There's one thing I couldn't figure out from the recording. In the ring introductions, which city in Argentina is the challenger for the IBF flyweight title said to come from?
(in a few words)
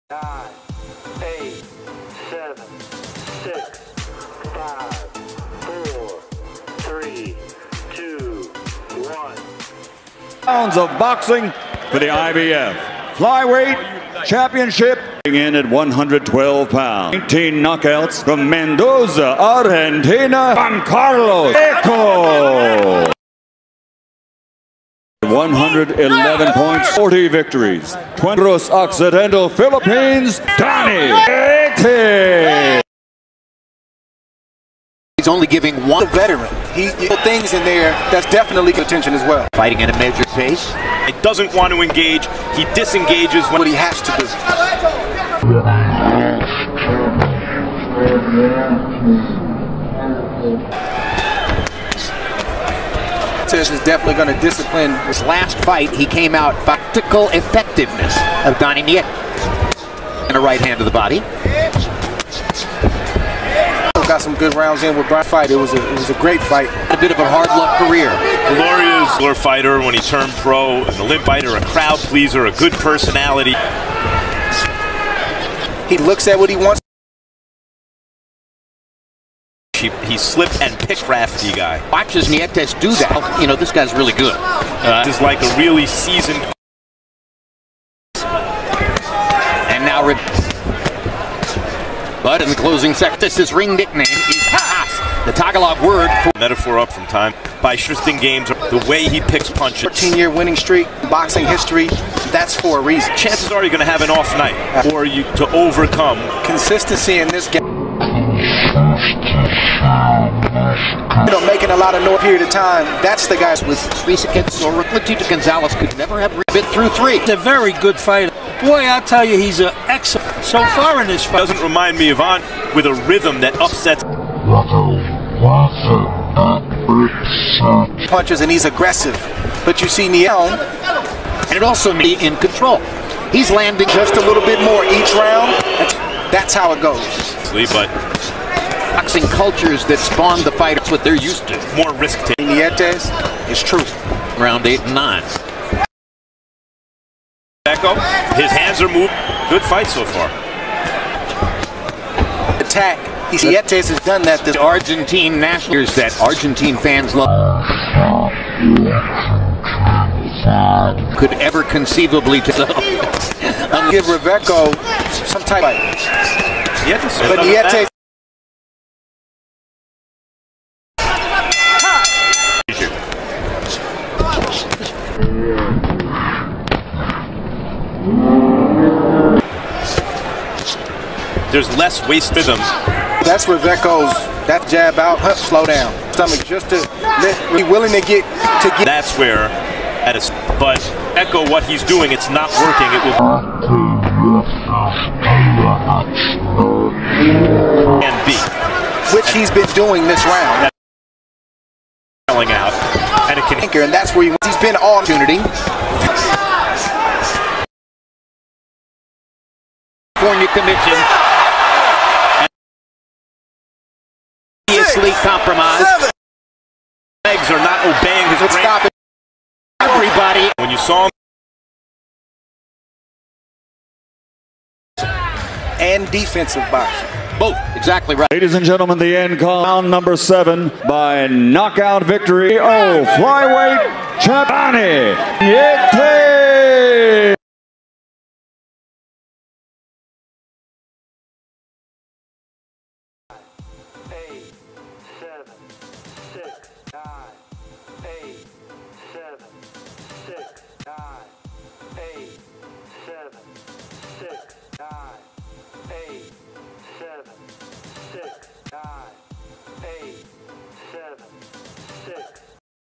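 Mendoza.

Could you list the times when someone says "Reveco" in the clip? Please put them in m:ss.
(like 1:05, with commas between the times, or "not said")
0:21, 2:44.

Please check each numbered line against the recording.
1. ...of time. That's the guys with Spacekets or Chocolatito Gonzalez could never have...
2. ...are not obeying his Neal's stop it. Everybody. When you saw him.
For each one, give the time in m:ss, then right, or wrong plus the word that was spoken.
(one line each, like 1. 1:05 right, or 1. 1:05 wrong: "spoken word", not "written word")
1. 1:52 right
2. 3:37 wrong: "Let", not "Neal".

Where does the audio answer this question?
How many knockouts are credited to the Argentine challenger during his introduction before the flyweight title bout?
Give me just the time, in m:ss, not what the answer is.
0:17.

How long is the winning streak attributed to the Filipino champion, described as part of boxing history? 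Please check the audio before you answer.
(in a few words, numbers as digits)
14 years.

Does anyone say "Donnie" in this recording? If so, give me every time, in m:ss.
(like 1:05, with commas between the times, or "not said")
0:30, 0:58.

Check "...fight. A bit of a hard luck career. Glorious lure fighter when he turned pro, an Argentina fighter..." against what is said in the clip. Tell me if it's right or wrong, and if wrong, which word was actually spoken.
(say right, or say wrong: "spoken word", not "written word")
wrong: "Olymp", not "Argentina".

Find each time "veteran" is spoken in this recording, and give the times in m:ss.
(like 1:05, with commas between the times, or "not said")
0:36.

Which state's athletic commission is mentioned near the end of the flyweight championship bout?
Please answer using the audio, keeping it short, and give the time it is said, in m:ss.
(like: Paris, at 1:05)
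California, at 3:30.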